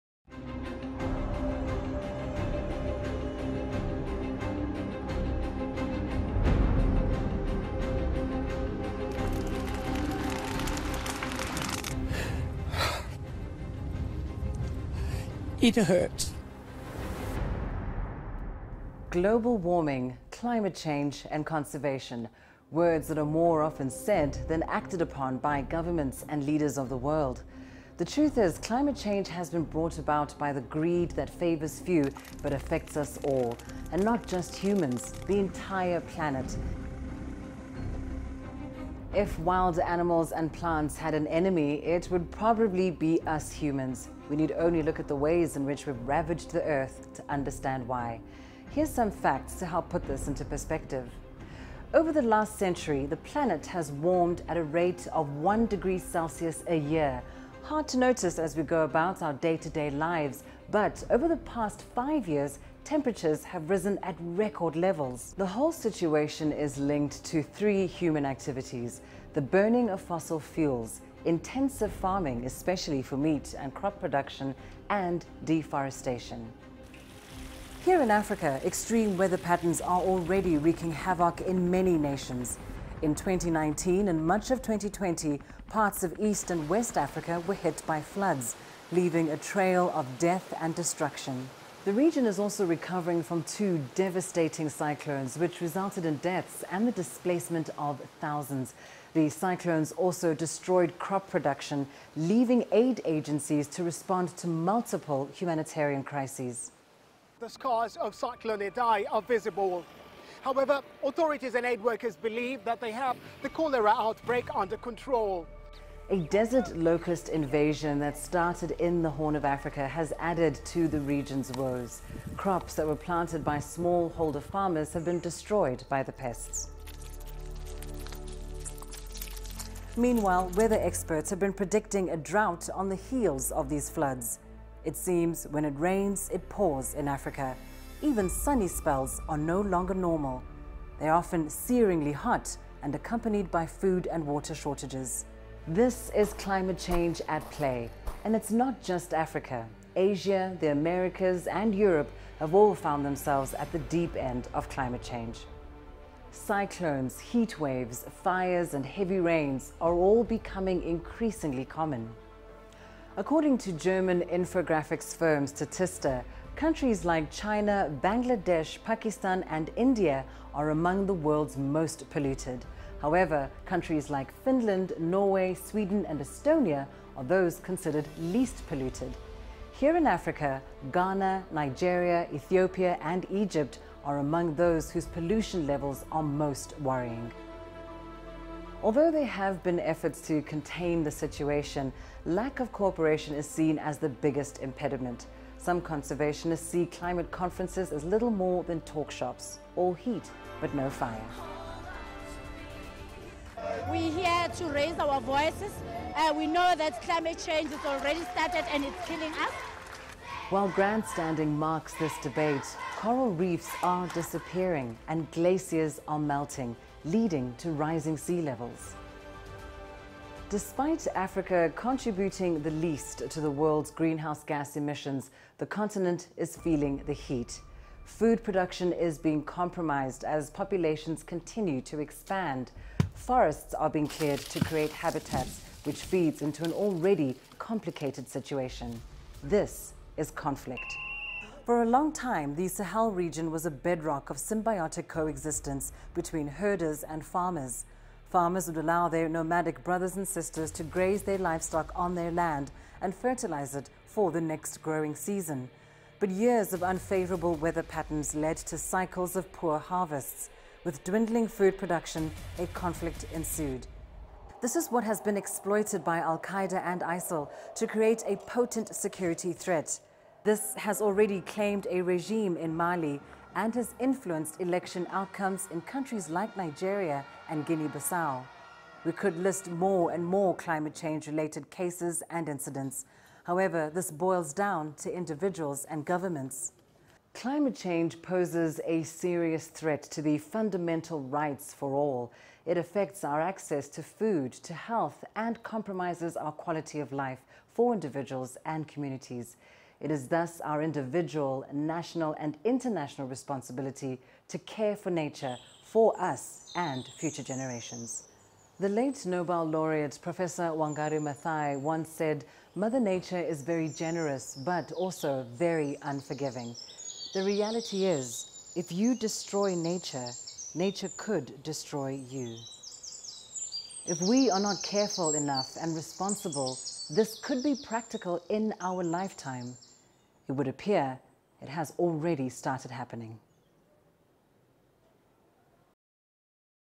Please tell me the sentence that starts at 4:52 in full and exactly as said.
It affects our access to food, to health, and compromises our quality of life for individuals and communities.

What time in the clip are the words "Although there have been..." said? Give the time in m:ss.
3:08.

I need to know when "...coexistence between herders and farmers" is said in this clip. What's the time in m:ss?
4:05.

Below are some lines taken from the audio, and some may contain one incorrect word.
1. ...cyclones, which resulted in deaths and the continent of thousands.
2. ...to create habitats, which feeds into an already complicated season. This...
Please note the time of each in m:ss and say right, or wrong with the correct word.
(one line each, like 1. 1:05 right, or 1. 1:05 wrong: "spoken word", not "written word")
1. 1:34 wrong: "displacement", not "continent"
2. 3:54 wrong: "situation", not "season".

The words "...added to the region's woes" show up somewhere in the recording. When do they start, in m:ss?
2:00.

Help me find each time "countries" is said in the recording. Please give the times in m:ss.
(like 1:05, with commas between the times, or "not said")
2:46, 2:53, 4:35.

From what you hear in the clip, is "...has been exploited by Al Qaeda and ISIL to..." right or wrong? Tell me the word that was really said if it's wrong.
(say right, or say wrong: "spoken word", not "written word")
right.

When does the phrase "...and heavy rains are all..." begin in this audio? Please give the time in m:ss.
2:38.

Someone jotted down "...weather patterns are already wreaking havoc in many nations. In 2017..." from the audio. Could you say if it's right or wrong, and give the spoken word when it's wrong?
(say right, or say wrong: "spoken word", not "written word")
wrong: "2019", not "2017".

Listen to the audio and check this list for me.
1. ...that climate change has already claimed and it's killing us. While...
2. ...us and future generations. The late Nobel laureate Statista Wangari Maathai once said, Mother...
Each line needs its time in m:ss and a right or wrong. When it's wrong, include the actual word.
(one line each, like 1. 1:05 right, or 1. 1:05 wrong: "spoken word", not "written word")
1. 3:26 wrong: "started", not "claimed"
2. 5:06 wrong: "Professor", not "Statista".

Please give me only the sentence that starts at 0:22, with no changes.
Words that are more often said than acted upon by governments and leaders of the world.